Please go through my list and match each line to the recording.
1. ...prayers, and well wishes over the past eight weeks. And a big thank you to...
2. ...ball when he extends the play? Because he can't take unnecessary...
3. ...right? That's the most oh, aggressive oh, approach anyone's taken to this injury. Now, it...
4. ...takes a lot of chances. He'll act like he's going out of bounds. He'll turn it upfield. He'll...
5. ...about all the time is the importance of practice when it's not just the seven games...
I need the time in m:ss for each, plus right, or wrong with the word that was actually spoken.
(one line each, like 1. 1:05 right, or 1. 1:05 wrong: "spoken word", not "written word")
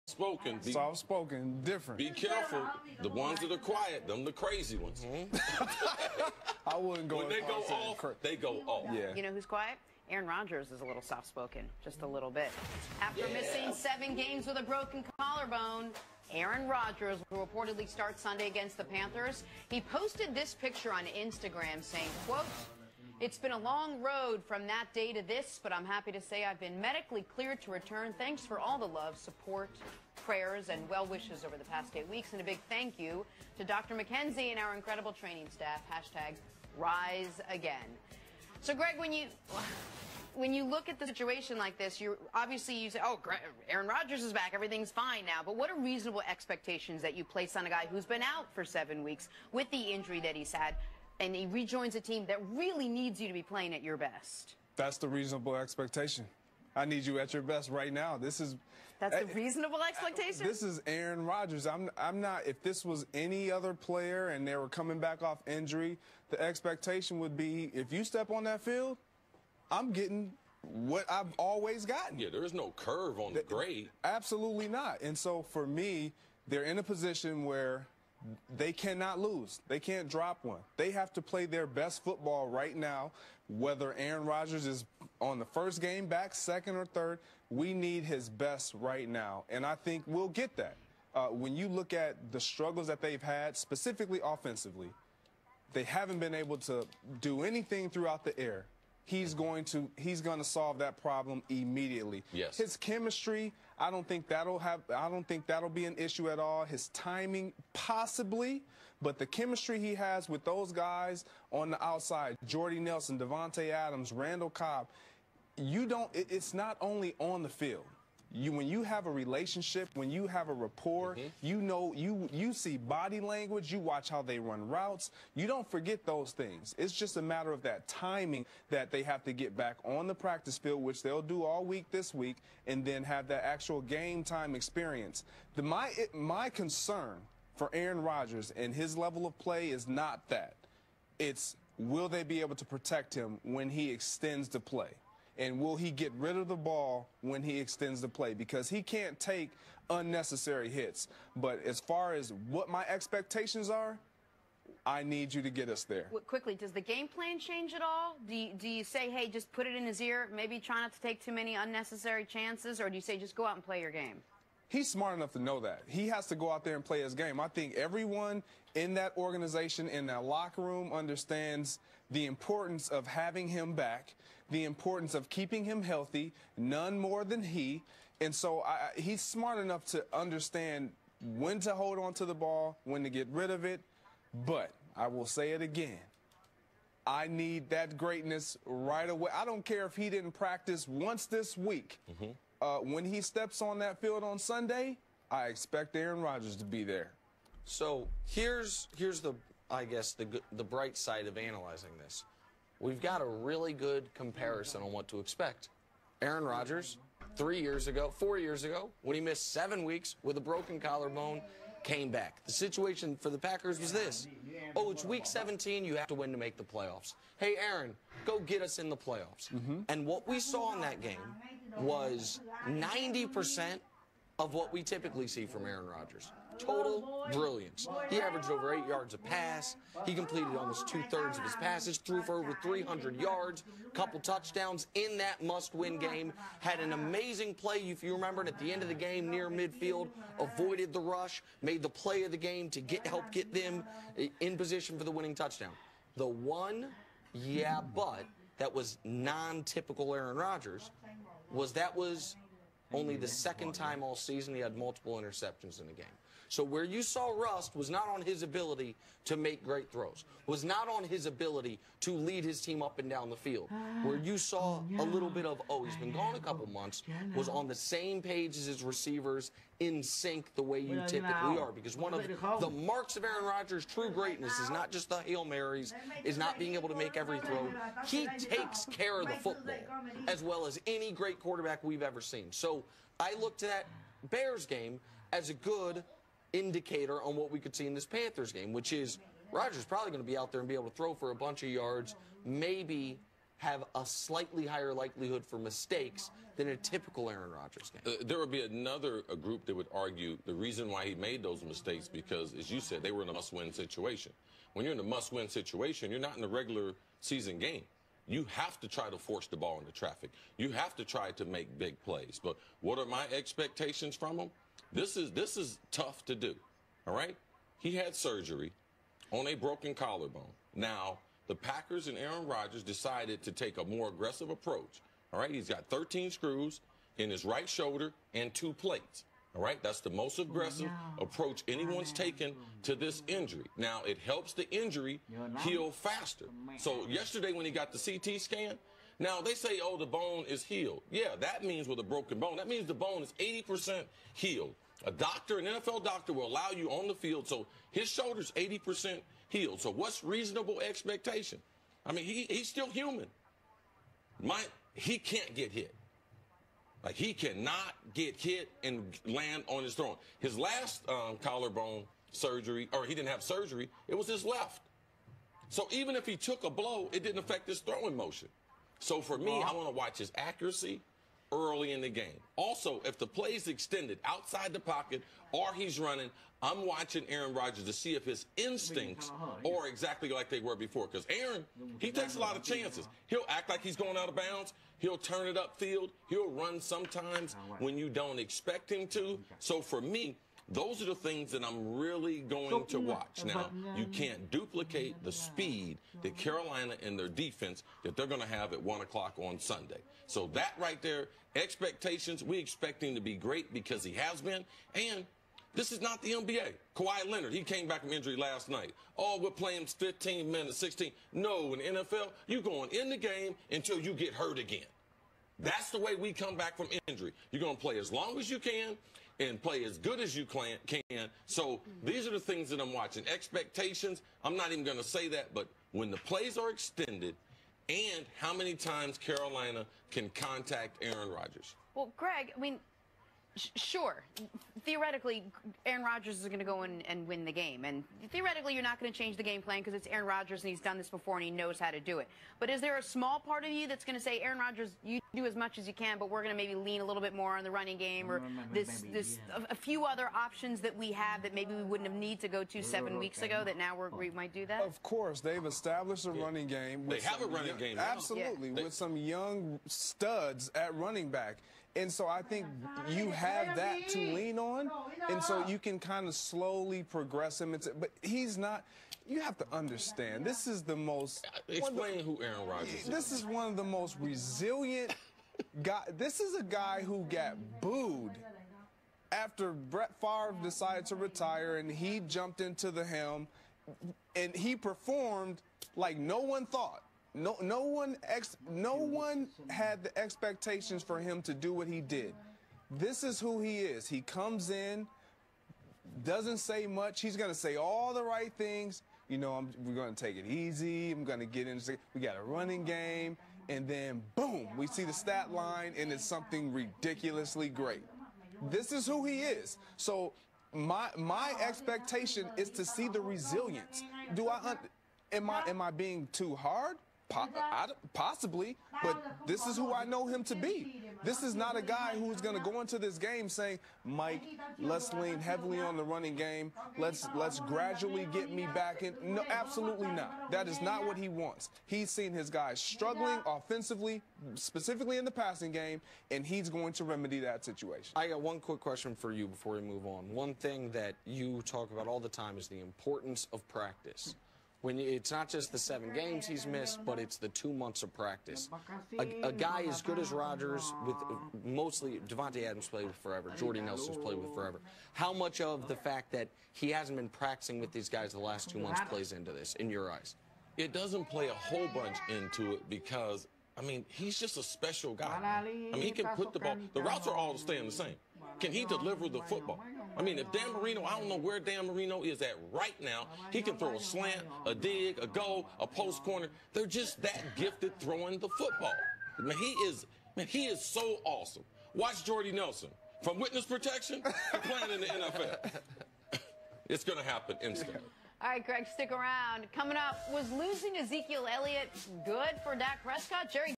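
1. 0:30 right
2. 2:26 right
3. 5:29 right
4. 6:22 right
5. 9:01 right.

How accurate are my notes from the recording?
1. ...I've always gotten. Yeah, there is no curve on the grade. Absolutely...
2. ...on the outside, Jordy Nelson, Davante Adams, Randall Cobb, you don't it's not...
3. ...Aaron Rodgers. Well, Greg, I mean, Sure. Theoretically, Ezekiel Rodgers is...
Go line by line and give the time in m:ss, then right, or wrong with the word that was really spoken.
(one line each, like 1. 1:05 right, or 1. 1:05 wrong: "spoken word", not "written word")
1. 1:11 right
2. 1:51 right
3. 7:11 wrong: "Aaron", not "Ezekiel".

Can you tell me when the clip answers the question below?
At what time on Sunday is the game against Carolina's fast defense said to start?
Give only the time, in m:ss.
6:38.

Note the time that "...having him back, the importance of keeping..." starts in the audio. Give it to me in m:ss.
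2:53.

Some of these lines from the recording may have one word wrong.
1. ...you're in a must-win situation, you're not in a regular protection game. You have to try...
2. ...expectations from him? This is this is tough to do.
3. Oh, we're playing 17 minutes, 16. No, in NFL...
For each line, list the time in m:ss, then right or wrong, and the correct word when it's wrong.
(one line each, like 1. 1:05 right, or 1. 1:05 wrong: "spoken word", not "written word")
1. 5:04 wrong: "season", not "protection"
2. 5:13 right
3. 6:49 wrong: "15", not "17".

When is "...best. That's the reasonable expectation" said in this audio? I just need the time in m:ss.
0:53.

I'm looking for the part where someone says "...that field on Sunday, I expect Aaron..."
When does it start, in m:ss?
3:13.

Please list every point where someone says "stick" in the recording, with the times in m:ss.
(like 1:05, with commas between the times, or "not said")
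9:48.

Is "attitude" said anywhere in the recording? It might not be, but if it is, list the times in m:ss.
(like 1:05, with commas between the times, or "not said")
not said.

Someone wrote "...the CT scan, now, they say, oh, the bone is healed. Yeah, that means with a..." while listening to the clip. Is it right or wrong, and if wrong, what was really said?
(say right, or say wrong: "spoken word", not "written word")
right.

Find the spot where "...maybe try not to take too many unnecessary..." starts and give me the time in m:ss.
2:40.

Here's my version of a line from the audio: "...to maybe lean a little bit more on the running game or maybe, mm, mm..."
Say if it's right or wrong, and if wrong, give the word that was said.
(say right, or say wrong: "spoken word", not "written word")
right.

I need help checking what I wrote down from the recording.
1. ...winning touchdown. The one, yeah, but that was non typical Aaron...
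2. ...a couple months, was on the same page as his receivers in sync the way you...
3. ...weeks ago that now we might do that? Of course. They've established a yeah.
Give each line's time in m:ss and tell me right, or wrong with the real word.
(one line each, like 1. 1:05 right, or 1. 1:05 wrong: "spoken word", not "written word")
1. 4:05 right
2. 4:26 right
3. 7:33 right.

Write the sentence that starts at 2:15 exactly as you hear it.
The, my it, my concern for Aaron Rodgers and his level of play is not that.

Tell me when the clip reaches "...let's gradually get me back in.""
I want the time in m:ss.
8:47.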